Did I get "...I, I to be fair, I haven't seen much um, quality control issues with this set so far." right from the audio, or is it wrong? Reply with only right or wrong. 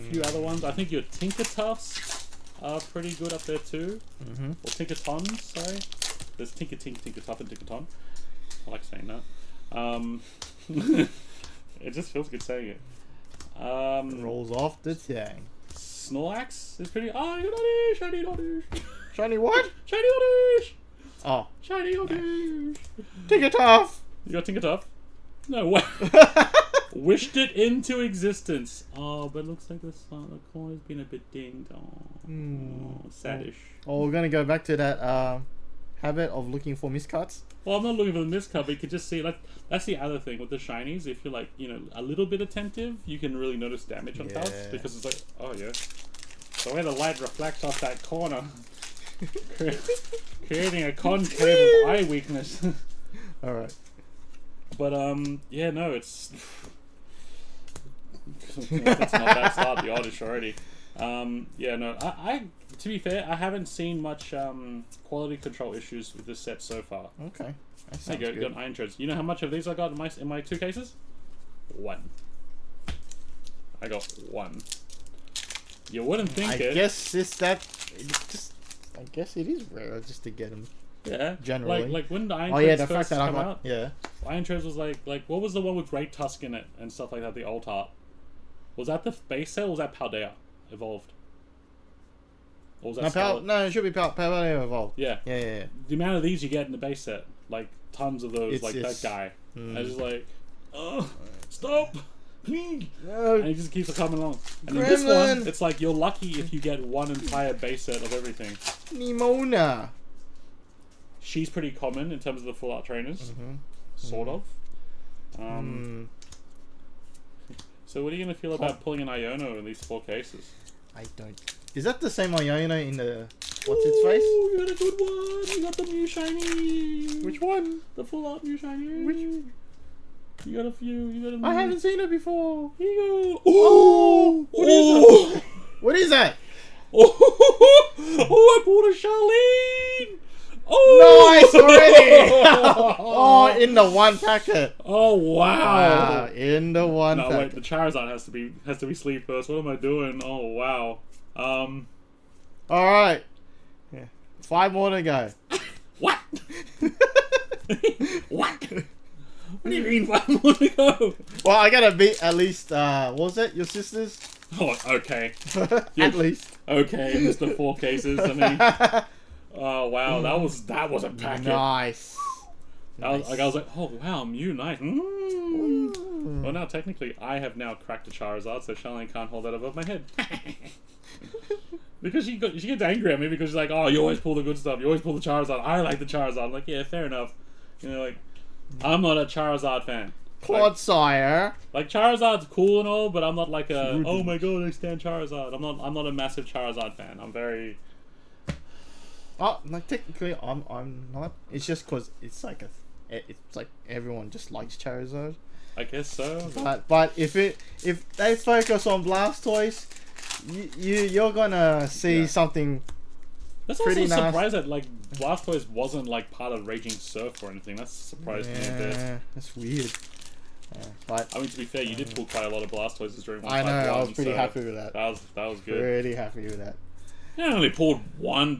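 right.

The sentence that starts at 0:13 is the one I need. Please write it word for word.
Um, it rolls off the tongue.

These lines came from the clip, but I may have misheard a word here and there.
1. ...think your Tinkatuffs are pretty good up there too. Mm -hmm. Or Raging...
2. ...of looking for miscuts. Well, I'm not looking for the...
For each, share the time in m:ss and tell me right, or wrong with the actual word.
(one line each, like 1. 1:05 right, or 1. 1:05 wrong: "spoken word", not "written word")
1. 0:00 wrong: "Tinkatons", not "Raging"
2. 0:36 right.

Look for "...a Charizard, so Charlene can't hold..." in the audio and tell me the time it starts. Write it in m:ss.
2:58.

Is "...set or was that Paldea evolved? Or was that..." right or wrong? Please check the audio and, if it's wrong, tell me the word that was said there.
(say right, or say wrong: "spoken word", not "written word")
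right.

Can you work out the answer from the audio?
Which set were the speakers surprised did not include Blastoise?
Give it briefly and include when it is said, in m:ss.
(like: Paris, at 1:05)
Raging Surf, at 3:36.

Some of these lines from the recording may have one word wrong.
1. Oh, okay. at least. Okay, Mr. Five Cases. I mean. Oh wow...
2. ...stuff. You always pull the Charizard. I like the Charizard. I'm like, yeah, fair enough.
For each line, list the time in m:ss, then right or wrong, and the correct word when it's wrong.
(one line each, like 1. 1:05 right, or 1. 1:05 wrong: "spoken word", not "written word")
1. 2:44 wrong: "Four", not "Five"
2. 3:04 right.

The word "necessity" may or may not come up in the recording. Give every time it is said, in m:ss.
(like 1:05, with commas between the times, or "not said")
not said.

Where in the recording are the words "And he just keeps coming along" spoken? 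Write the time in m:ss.
1:43.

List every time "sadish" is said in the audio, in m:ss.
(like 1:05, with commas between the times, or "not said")
0:33.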